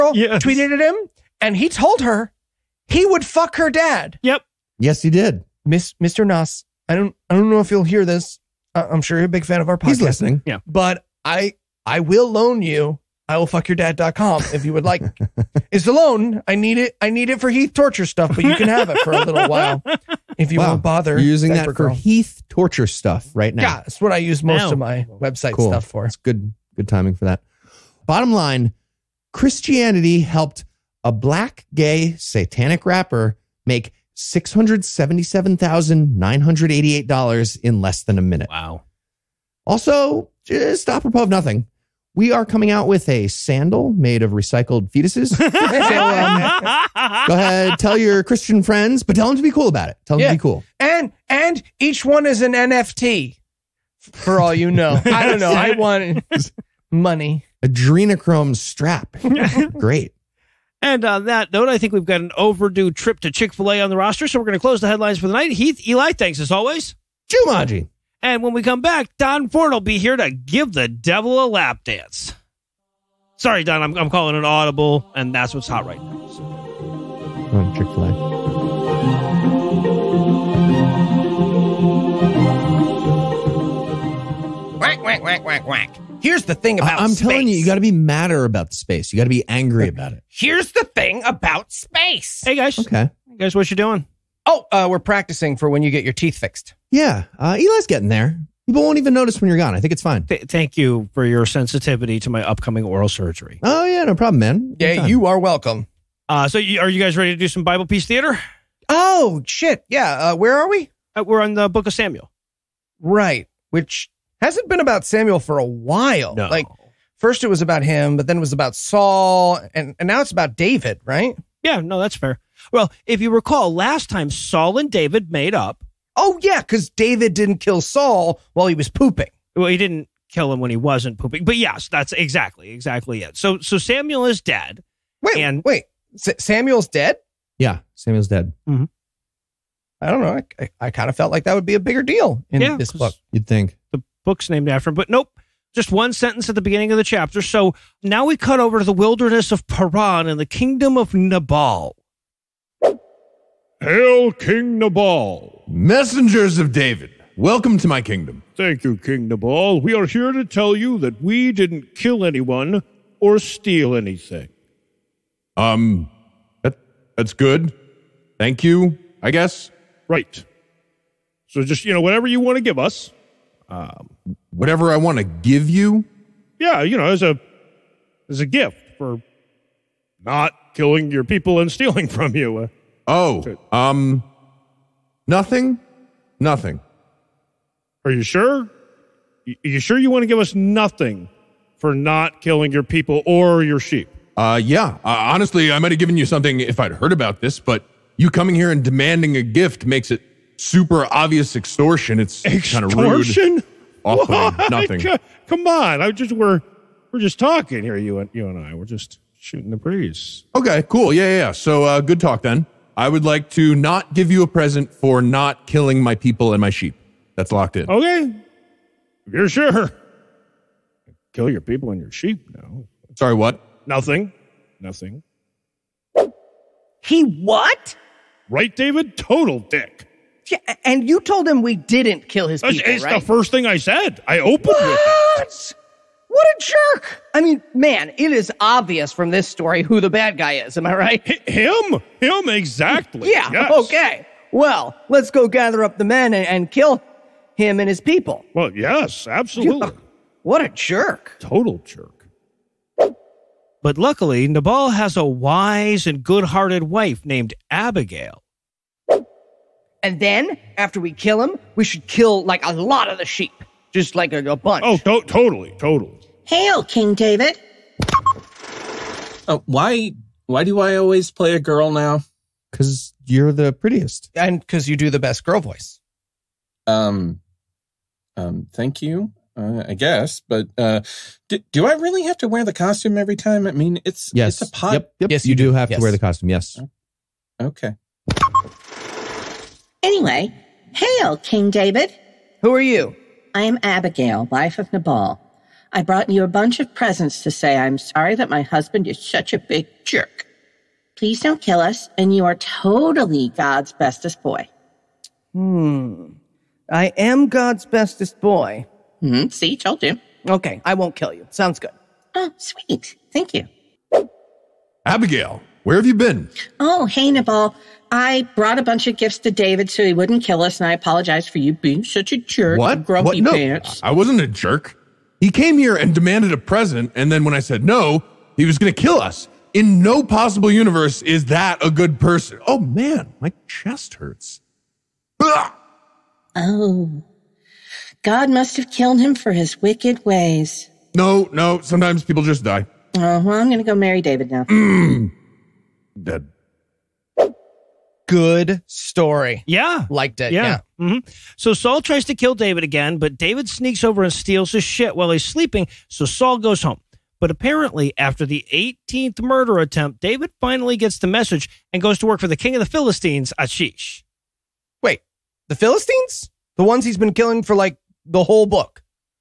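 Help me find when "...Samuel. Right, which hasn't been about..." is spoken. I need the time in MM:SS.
01:51.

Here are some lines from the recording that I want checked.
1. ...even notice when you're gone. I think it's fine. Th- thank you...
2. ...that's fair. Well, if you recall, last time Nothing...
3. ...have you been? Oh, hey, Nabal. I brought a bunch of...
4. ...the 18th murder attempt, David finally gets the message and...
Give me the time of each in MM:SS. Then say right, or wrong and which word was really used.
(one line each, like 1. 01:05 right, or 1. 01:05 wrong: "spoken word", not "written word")
1. 01:38 right
2. 02:02 wrong: "Saul", not "Nothing"
3. 05:15 right
4. 05:58 right.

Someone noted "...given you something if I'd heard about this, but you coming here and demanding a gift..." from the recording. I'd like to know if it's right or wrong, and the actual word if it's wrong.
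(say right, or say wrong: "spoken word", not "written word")
right.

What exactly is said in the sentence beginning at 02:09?
Well, he didn't kill him when he wasn't pooping.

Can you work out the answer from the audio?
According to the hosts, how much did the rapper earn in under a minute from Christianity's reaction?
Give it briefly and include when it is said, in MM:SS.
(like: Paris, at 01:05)
$677,988, at 00:34.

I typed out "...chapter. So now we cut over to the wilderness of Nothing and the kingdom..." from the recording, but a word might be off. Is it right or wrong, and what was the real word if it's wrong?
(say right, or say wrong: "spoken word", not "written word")
wrong: "Paran", not "Nothing".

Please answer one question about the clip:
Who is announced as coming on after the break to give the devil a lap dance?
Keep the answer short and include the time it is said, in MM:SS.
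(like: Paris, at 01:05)
Don Ford, at 01:09.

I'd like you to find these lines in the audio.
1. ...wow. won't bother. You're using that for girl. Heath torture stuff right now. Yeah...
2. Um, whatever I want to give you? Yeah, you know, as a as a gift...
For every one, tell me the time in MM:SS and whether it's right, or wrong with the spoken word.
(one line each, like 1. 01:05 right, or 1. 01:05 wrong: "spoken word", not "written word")
1. 00:20 right
2. 02:53 right.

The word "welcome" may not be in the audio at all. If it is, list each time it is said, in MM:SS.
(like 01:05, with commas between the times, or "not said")
01:45, 02:37.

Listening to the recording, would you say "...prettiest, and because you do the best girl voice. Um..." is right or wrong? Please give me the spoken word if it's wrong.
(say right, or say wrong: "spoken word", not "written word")
right.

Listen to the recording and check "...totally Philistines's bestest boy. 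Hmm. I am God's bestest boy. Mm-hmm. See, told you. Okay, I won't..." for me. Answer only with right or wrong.
wrong.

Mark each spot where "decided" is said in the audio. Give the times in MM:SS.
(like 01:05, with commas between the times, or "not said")
not said.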